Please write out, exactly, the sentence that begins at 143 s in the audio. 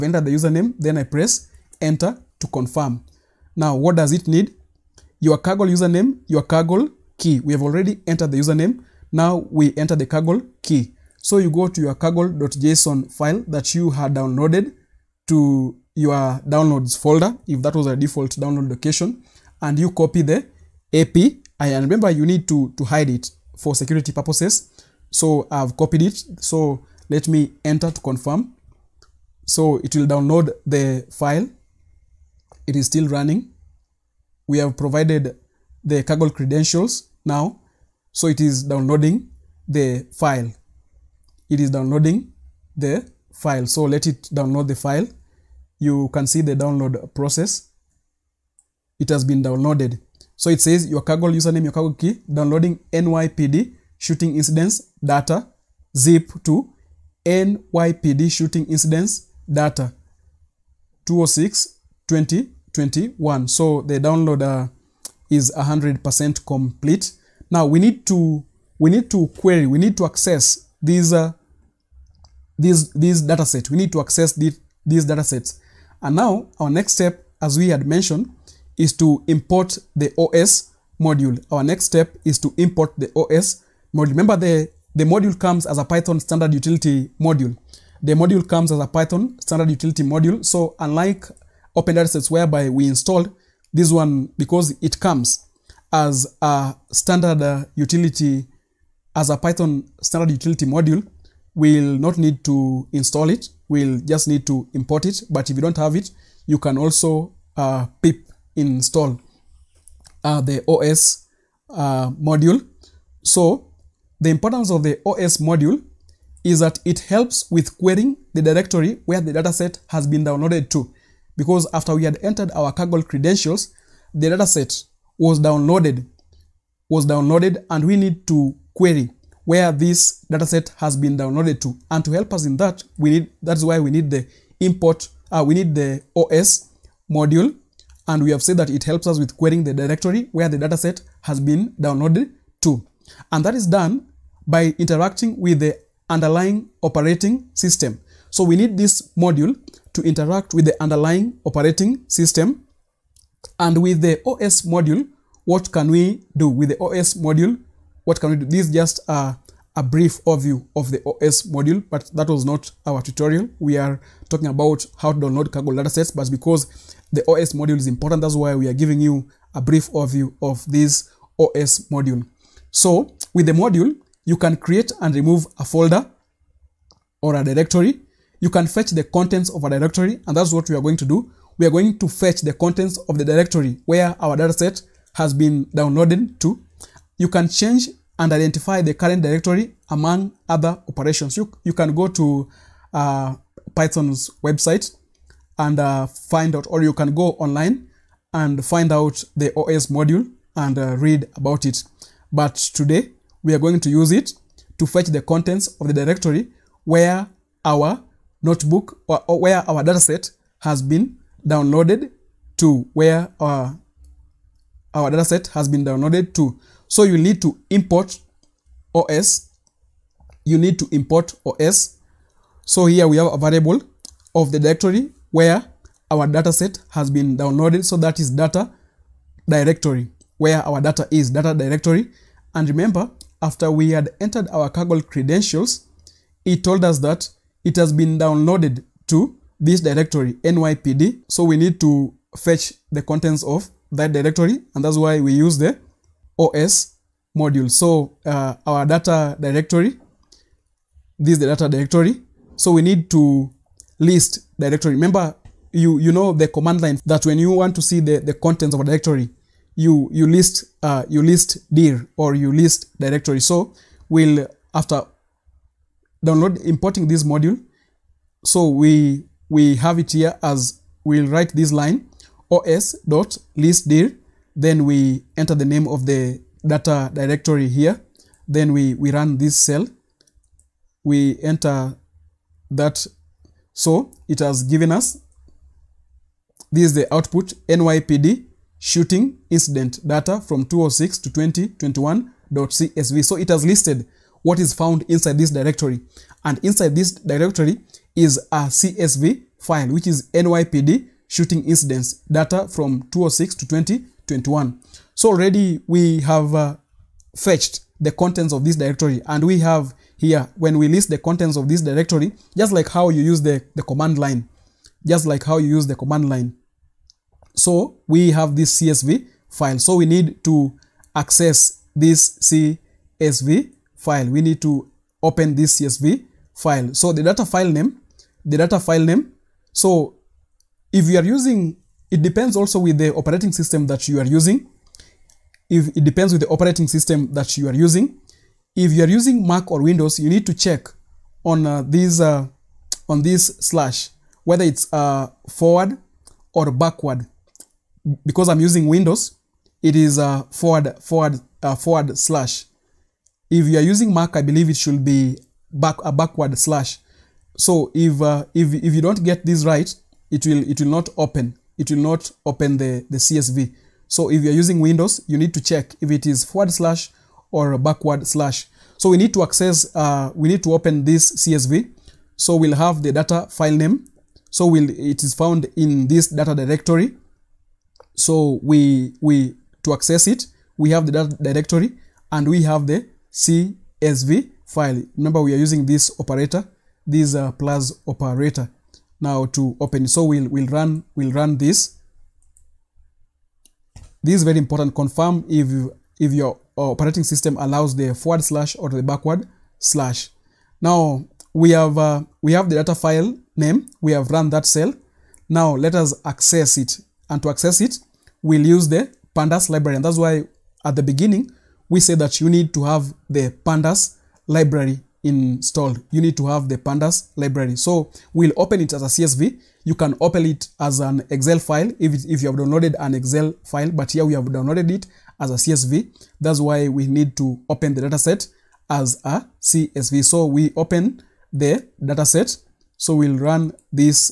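And that is done by interacting with the underlying operating system.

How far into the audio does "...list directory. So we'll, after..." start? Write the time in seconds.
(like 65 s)
262 s.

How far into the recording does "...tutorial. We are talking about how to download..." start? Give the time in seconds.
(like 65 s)
163 s.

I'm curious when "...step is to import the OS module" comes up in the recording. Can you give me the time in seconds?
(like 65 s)
81 s.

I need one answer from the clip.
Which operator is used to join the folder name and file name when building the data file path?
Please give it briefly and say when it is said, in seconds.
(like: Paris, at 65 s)
plus operator, at 387 s.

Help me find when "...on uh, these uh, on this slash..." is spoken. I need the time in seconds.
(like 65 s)
341 s.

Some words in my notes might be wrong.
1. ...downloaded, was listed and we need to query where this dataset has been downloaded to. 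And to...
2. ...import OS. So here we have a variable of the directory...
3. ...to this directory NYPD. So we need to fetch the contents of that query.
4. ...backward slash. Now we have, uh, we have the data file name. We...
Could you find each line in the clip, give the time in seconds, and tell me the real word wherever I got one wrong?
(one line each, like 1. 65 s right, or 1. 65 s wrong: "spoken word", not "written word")
1. 125 s wrong: "downloaded", not "listed"
2. 220 s right
3. 239 s wrong: "directory", not "query"
4. 399 s right.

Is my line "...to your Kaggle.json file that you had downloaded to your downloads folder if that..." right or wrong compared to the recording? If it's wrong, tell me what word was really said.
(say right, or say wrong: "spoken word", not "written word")
right.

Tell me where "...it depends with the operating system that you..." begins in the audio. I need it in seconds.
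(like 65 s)
335 s.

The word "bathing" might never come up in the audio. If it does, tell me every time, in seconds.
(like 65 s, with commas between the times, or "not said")
not said.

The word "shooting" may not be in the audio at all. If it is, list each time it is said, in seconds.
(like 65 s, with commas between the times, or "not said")
53 s, 58 s, 288 s, 301 s.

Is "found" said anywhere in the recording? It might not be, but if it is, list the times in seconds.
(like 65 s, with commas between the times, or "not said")
294 s, 375 s.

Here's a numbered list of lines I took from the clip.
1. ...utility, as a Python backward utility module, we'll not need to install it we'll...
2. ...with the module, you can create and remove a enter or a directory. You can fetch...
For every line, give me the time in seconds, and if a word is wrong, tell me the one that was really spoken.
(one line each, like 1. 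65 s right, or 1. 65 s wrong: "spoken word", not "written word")
1. 97 s wrong: "standard", not "backward"
2. 173 s wrong: "folder", not "enter".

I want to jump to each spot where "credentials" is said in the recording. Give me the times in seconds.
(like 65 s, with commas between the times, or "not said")
36 s, 123 s, 235 s.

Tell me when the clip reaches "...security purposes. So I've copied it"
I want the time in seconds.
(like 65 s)
23 s.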